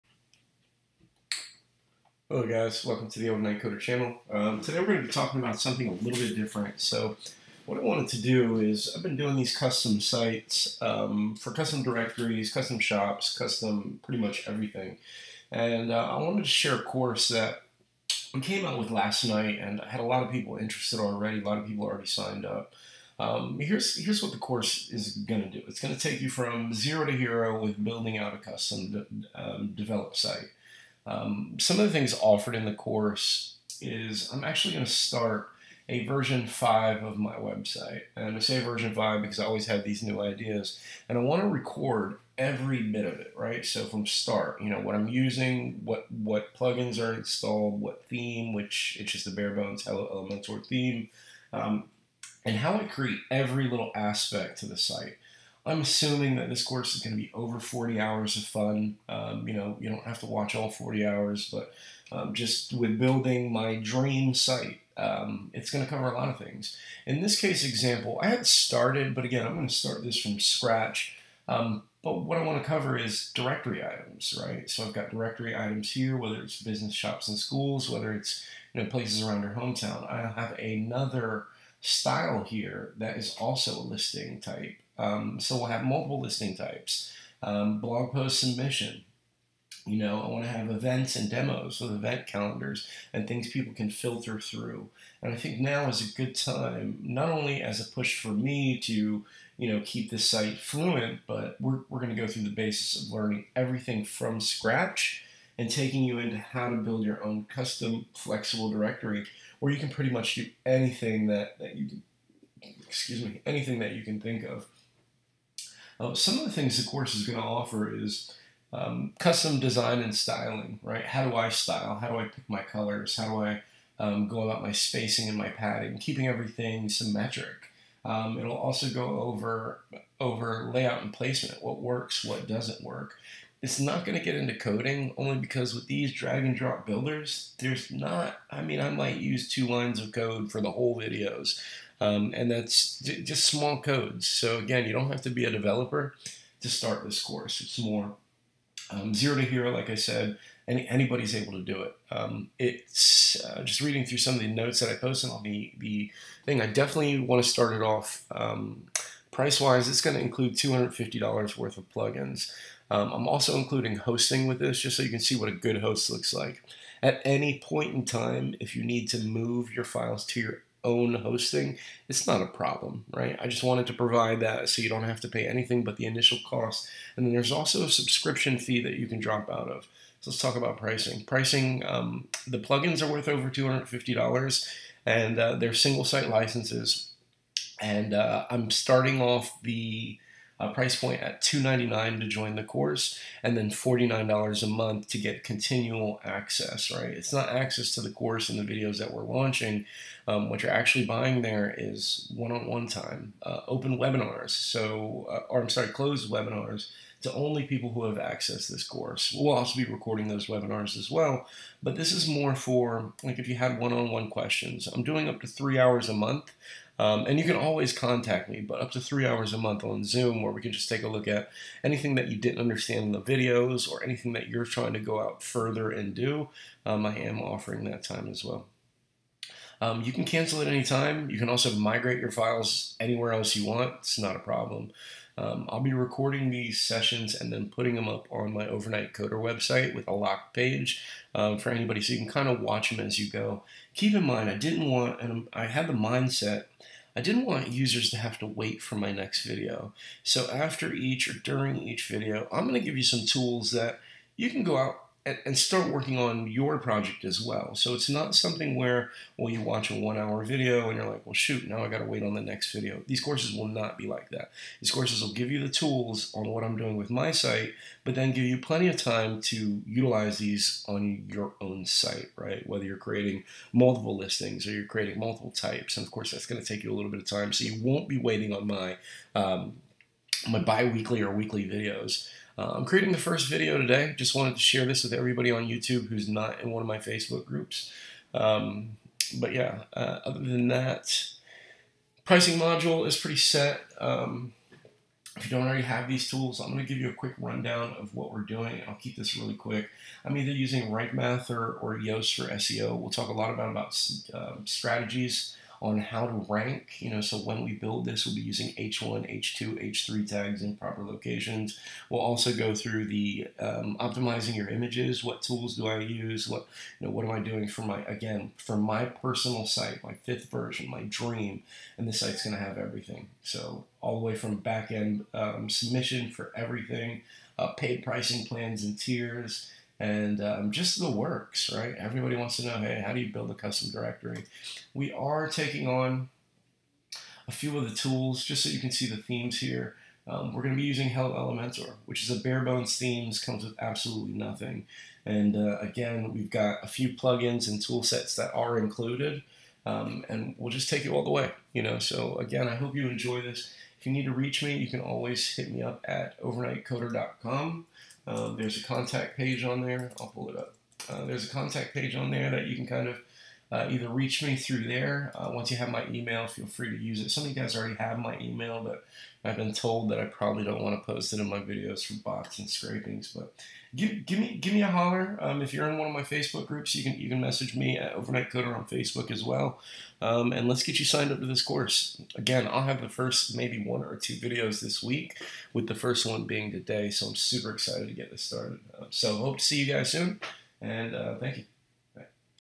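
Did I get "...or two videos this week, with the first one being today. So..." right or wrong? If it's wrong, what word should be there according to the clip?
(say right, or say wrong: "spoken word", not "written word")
right.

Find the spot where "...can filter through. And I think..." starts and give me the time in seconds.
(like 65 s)
93 s.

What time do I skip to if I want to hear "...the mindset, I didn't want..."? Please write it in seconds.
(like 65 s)
245 s.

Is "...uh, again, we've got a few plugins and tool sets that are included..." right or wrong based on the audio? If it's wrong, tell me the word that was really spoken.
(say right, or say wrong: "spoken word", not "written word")
right.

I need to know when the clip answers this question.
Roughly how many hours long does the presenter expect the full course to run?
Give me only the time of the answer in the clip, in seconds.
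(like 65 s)
57 s.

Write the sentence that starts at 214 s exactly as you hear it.
I'm doing up to three hours a month.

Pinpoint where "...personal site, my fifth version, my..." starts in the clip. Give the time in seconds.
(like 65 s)
319 s.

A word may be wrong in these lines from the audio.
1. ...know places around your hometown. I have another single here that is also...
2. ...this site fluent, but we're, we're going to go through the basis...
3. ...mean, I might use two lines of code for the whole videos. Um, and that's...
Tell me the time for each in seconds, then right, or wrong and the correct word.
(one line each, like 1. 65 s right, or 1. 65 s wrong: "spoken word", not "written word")
1. 78 s wrong: "style", not "single"
2. 100 s right
3. 138 s right.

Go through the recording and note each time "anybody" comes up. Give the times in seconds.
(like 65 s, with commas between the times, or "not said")
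150 s, 241 s.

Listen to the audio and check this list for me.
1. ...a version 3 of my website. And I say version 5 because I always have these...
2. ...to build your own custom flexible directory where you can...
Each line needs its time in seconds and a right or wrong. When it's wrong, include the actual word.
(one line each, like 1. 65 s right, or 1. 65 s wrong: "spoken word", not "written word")
1. 35 s wrong: "5", not "3"
2. 106 s right.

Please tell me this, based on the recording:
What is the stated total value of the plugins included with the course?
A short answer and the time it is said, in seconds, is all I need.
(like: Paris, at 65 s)
$250, at 160 s.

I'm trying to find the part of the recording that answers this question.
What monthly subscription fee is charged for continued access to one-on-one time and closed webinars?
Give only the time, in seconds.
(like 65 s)
193 s.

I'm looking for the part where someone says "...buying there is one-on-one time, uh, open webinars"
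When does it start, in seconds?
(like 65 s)
201 s.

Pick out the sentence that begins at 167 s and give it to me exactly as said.
At any point in time, if you need to move your files to your own hosting, it's not a problem, right?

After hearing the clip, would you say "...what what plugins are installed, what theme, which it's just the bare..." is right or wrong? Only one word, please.
right.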